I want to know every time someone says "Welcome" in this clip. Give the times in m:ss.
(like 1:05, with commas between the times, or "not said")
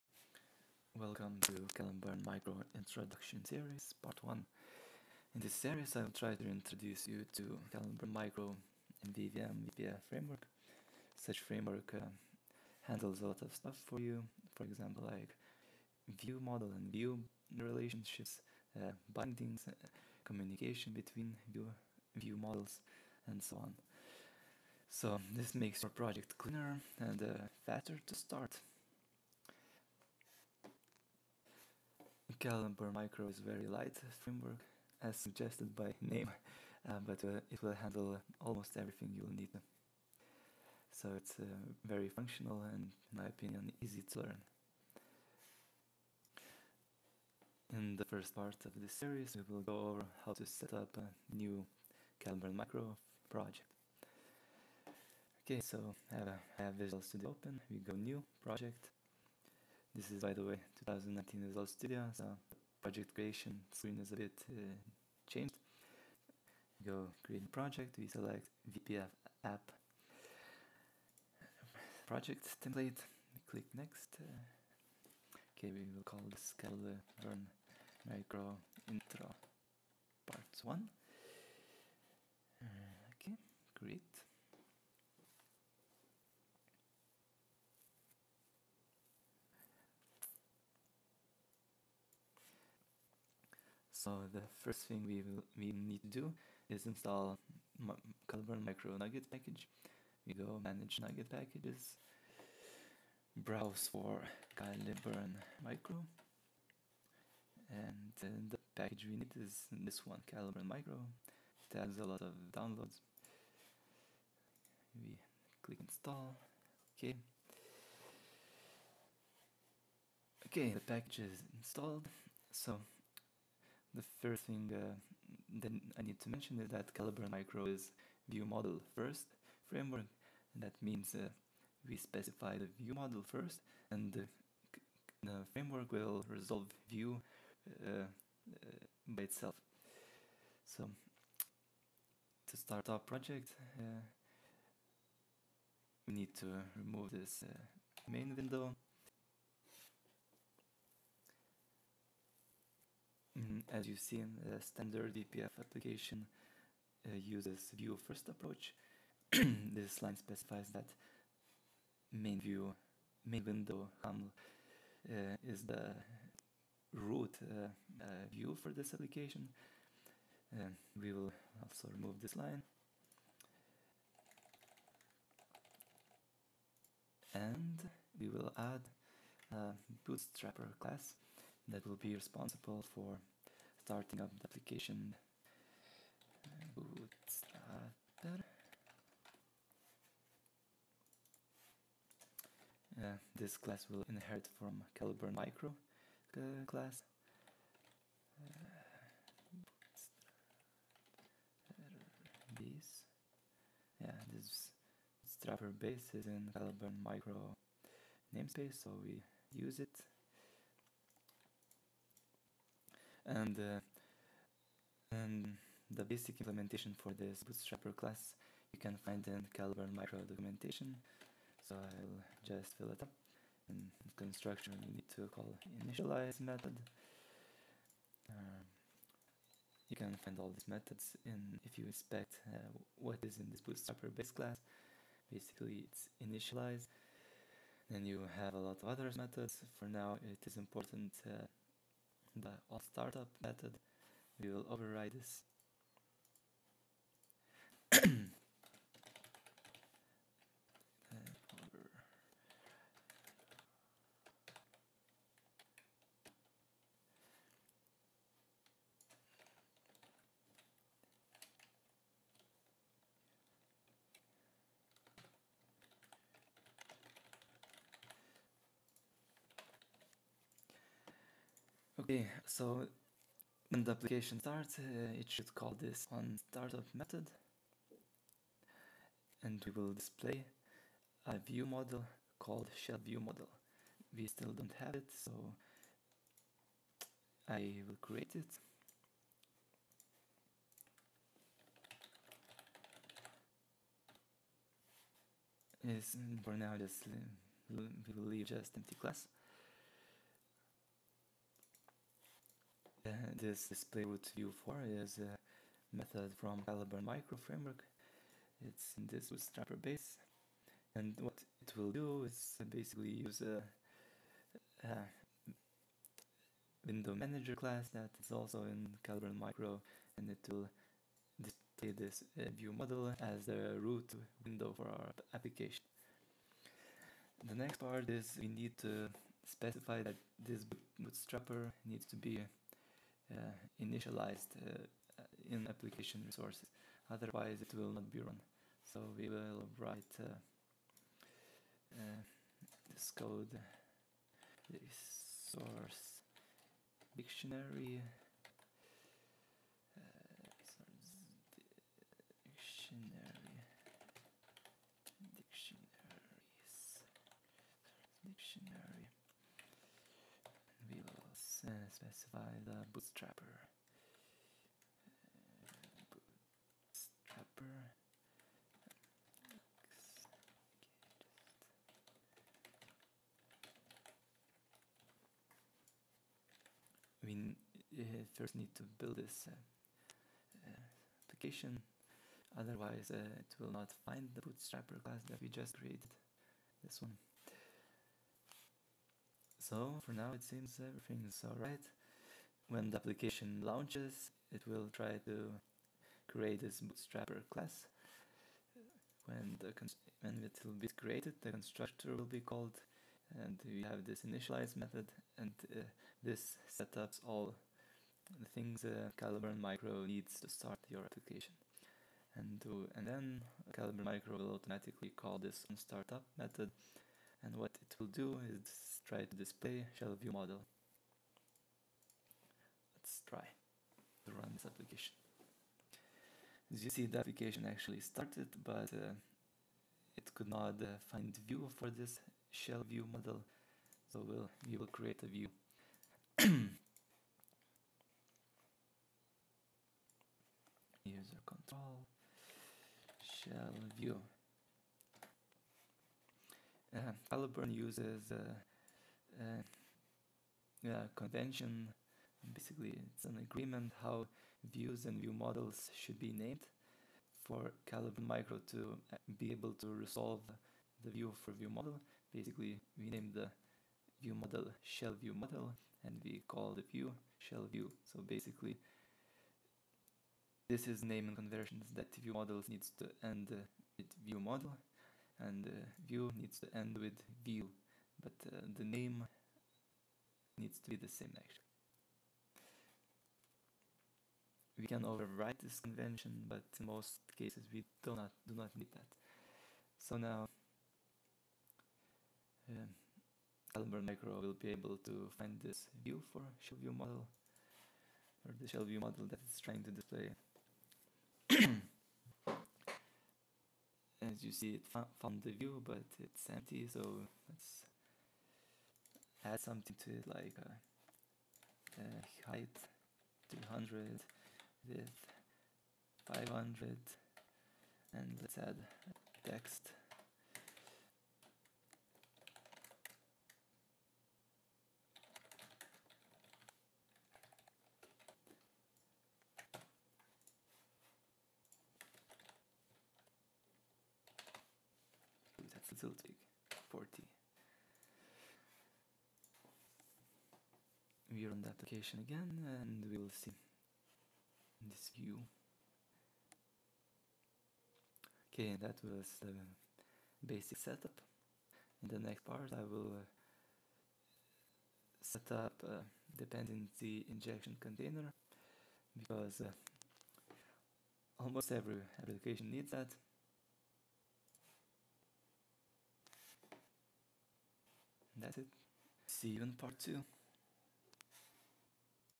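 0:00.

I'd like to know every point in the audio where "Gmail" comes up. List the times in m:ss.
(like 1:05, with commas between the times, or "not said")
not said.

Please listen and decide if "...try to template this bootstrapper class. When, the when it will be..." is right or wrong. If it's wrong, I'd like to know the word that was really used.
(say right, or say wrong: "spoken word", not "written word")
wrong: "create", not "template".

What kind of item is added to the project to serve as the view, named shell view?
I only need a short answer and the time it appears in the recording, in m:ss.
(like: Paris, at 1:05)
User control, at 7:21.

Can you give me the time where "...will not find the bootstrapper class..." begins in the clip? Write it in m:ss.
6:23.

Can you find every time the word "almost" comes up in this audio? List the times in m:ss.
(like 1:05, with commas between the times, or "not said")
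0:38, 9:21.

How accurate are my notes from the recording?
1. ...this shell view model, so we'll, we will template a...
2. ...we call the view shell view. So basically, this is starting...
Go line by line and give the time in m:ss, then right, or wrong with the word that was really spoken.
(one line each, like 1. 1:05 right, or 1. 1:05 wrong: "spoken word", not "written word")
1. 7:11 wrong: "create", not "template"
2. 7:46 wrong: "naming", not "starting".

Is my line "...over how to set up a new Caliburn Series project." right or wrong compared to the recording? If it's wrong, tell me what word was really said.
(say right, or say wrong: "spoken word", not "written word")
wrong: "Micro", not "Series".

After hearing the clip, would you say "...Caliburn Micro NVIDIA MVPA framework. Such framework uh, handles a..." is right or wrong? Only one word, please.
right.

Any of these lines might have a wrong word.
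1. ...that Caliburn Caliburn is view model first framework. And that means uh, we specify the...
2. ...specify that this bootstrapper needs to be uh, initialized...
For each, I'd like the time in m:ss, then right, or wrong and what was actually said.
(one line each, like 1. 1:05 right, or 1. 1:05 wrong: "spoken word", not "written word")
1. 2:06 wrong: "Micro", not "Caliburn"
2. 5:29 right.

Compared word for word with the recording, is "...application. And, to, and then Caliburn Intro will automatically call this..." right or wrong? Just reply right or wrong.
wrong.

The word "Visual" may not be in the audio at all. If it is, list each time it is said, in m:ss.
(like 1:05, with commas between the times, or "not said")
0:56, 1:01.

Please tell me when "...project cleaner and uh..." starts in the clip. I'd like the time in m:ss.
0:25.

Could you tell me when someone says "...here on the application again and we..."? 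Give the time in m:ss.
9:01.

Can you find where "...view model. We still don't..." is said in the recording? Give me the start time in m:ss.
4:43.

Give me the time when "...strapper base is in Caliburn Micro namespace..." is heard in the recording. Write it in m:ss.
3:25.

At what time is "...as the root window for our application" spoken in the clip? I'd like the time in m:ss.
5:23.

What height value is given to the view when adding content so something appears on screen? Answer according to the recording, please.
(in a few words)
200.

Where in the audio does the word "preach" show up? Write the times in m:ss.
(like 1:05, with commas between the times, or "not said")
not said.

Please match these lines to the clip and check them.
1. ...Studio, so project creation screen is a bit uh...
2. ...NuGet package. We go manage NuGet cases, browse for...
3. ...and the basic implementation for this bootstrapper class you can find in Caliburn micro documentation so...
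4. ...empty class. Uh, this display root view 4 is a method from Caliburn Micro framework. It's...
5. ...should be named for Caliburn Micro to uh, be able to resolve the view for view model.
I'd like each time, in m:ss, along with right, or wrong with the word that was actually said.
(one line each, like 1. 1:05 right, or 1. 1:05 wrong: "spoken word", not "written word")
1. 1:01 right
2. 1:38 wrong: "packages", not "cases"
3. 3:35 right
4. 4:58 right
5. 7:35 right.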